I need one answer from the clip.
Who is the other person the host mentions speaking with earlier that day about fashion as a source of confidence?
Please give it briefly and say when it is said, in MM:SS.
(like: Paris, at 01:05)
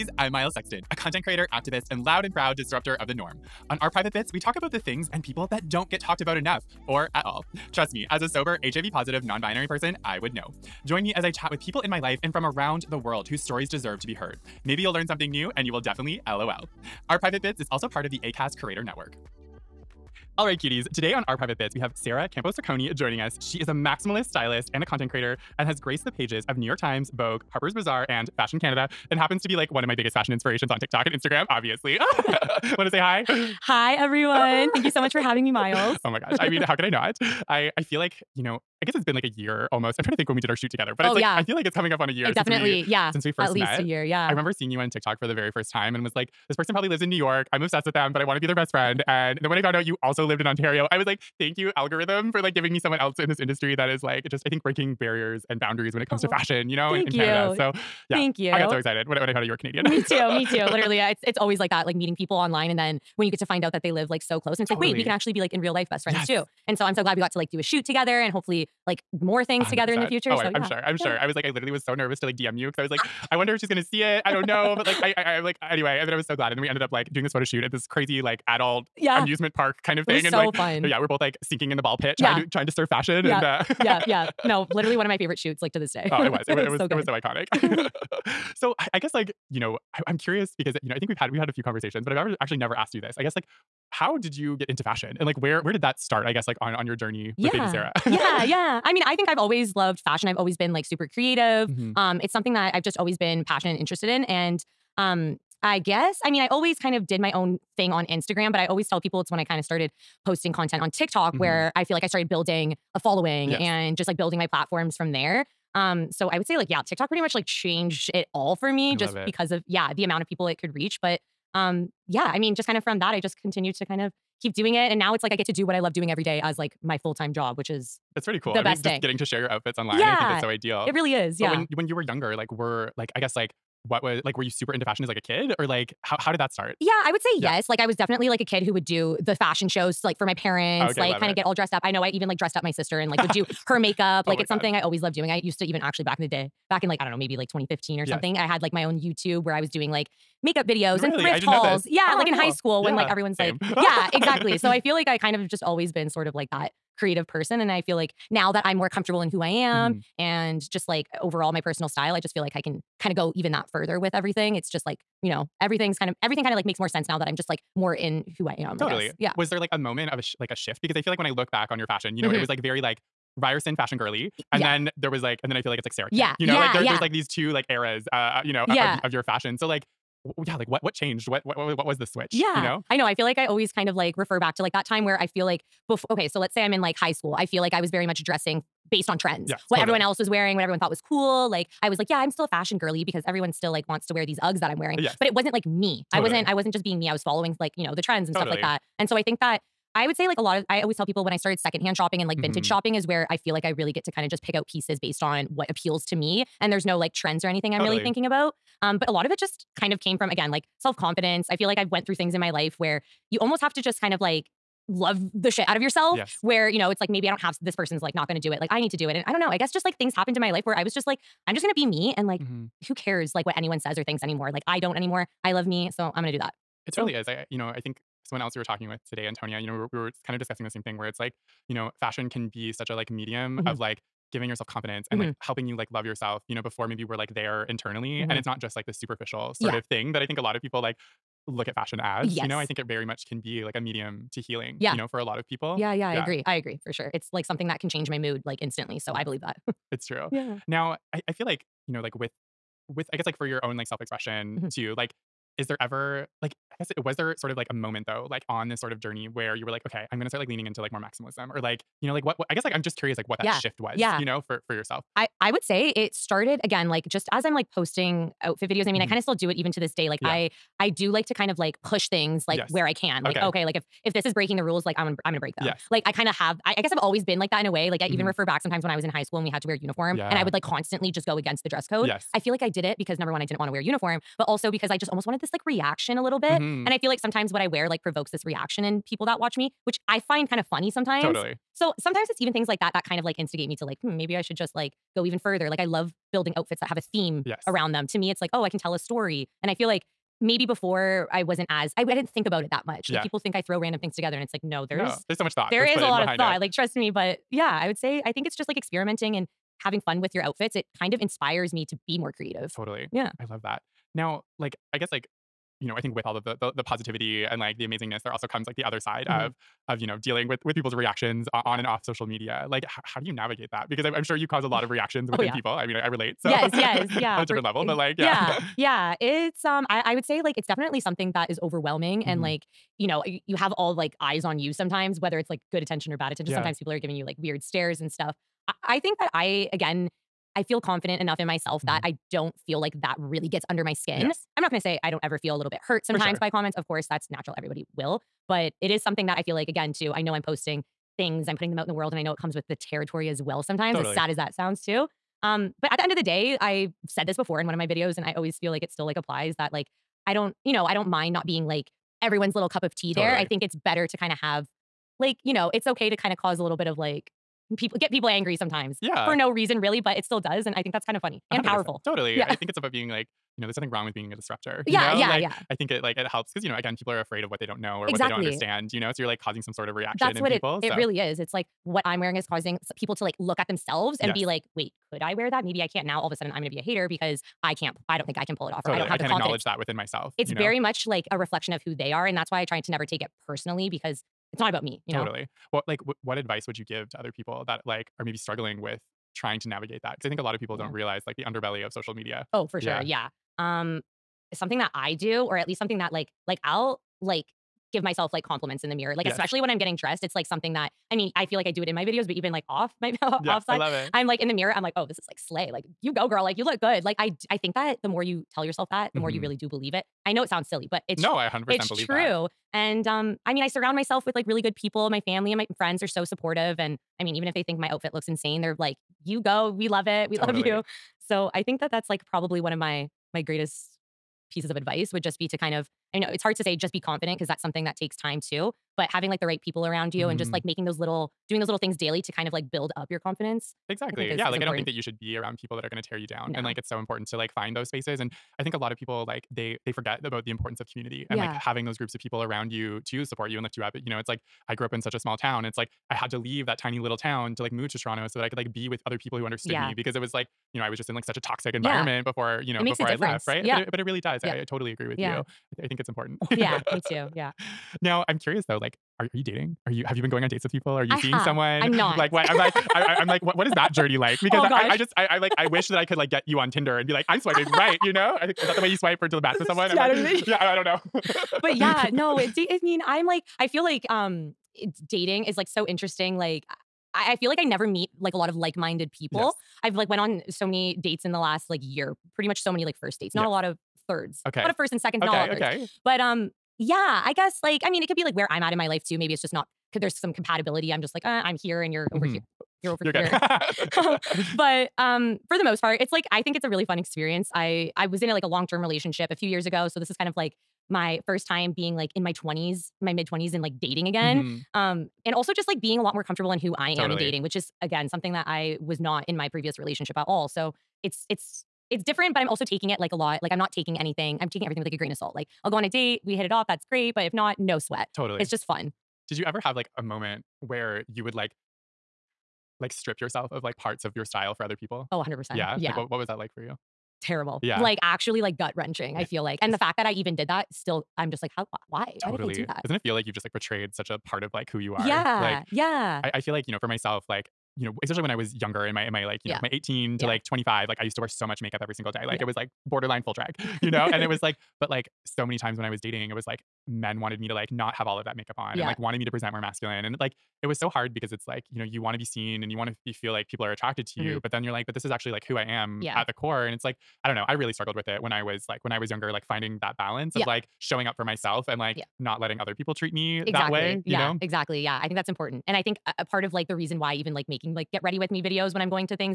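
Antonia, at 03:49.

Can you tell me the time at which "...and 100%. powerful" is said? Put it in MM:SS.
06:11.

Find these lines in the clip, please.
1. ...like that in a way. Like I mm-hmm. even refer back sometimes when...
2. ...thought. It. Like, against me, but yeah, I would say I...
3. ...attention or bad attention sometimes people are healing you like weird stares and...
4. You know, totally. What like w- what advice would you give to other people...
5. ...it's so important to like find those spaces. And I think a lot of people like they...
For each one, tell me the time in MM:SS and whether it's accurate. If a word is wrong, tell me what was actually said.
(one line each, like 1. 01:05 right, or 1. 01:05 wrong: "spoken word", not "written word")
1. 04:37 right
2. 05:06 wrong: "trust", not "against"
3. 05:35 wrong: "giving", not "healing"
4. 06:35 right
5. 07:26 right.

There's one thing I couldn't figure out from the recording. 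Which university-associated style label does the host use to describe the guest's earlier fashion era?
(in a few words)
Ryerson fashion girly.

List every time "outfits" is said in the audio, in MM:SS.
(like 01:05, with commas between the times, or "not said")
02:09, 04:28, 04:56, 05:10, 07:07.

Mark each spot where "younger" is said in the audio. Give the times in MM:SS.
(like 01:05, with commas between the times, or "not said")
02:12, 09:08, 09:29.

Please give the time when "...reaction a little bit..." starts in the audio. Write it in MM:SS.
04:45.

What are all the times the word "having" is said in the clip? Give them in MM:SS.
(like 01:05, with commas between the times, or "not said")
00:35, 05:09, 07:19, 07:31.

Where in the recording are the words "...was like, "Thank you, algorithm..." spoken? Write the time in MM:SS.
00:50.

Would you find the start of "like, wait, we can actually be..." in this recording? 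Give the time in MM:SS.
01:04.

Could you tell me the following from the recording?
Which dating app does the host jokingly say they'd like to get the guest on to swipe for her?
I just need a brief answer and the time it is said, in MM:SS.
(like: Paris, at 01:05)
Tinder, at 07:56.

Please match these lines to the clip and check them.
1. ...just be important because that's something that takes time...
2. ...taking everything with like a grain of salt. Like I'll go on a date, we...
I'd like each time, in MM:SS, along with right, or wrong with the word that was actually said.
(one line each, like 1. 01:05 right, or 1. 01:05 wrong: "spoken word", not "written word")
1. 07:16 wrong: "confident", not "important"
2. 08:44 right.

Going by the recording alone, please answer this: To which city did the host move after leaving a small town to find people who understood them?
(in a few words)
Toronto.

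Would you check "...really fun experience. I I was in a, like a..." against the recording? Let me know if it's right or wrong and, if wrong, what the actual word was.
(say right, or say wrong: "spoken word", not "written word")
right.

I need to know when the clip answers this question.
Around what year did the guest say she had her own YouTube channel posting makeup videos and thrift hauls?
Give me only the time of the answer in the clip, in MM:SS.
02:27.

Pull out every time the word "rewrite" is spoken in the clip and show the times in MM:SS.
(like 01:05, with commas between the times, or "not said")
not said.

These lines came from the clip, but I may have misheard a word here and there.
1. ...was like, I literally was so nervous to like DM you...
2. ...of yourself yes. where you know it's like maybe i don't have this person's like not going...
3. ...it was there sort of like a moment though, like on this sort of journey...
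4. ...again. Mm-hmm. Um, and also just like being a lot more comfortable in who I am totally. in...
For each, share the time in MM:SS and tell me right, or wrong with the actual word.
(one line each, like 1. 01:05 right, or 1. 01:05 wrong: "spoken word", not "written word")
1. 01:11 right
2. 03:35 right
3. 04:16 right
4. 08:34 right.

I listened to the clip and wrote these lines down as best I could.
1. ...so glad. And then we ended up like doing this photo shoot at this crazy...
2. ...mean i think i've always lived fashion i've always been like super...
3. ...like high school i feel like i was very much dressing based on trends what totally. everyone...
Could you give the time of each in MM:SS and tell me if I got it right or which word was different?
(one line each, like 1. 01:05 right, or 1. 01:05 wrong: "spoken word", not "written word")
1. 01:16 right
2. 01:38 wrong: "loved", not "lived"
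3. 03:06 right.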